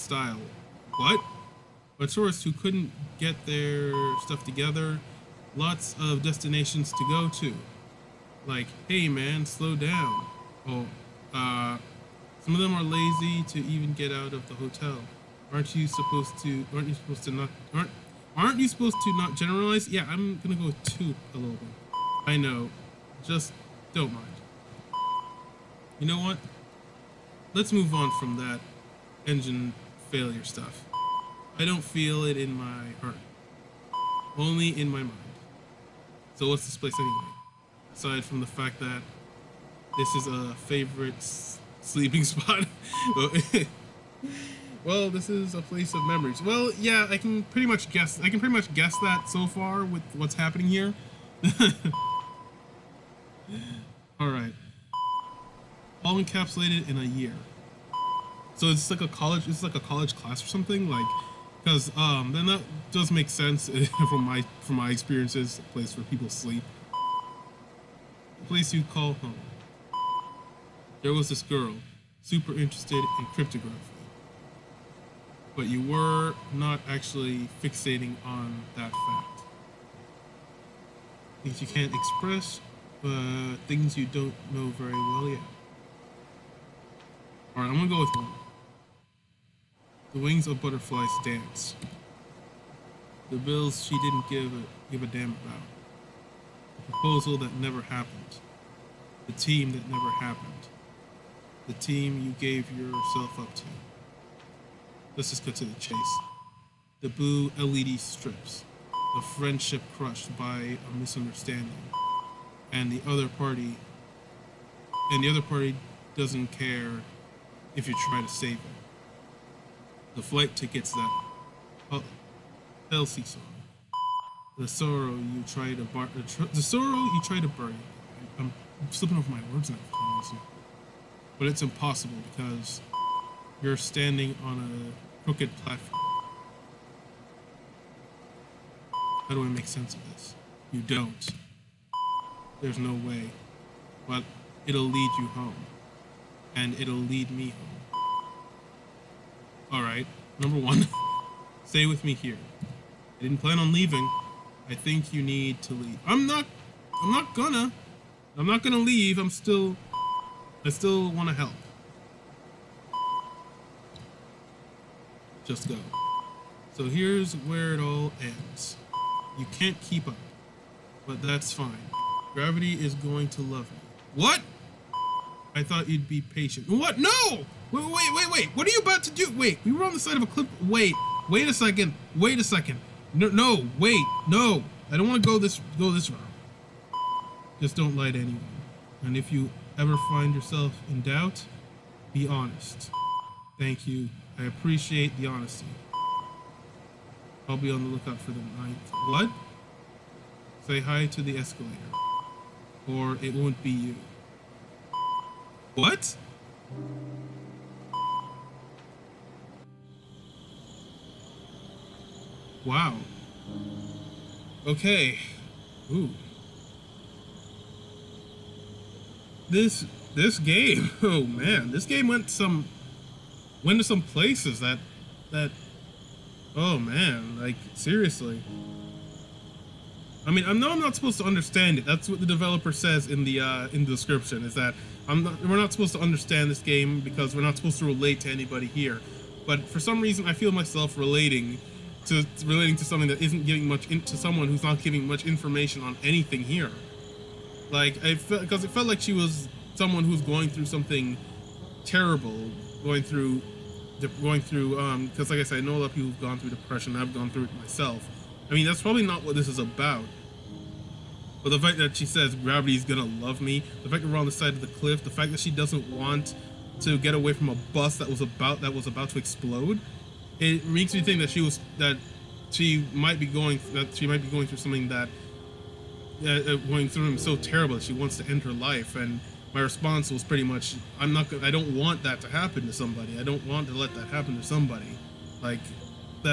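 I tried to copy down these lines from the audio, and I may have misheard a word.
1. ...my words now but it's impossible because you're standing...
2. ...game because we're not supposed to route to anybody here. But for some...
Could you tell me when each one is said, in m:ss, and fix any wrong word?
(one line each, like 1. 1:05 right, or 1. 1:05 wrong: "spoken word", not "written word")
1. 2:09 right
2. 3:56 wrong: "relate", not "route".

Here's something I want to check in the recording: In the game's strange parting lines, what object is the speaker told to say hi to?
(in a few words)
the escalator.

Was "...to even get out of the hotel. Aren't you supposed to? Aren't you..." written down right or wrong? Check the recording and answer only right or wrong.
right.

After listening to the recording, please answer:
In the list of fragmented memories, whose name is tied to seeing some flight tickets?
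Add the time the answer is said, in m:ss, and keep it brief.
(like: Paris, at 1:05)
Elsie, at 2:02.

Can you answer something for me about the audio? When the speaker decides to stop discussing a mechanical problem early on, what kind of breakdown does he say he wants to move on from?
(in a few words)
engine failure.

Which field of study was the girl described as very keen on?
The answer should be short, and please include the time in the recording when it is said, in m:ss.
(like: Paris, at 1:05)
cryptography, at 1:13.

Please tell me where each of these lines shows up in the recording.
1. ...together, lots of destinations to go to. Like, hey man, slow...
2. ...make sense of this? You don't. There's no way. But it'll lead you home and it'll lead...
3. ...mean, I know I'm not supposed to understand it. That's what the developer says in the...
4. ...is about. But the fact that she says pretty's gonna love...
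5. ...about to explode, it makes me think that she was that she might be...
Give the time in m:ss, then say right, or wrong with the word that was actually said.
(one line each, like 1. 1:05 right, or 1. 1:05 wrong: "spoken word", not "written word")
1. 0:04 right
2. 2:19 right
3. 3:50 right
4. 4:19 wrong: "gravity", not "pretty"
5. 4:28 right.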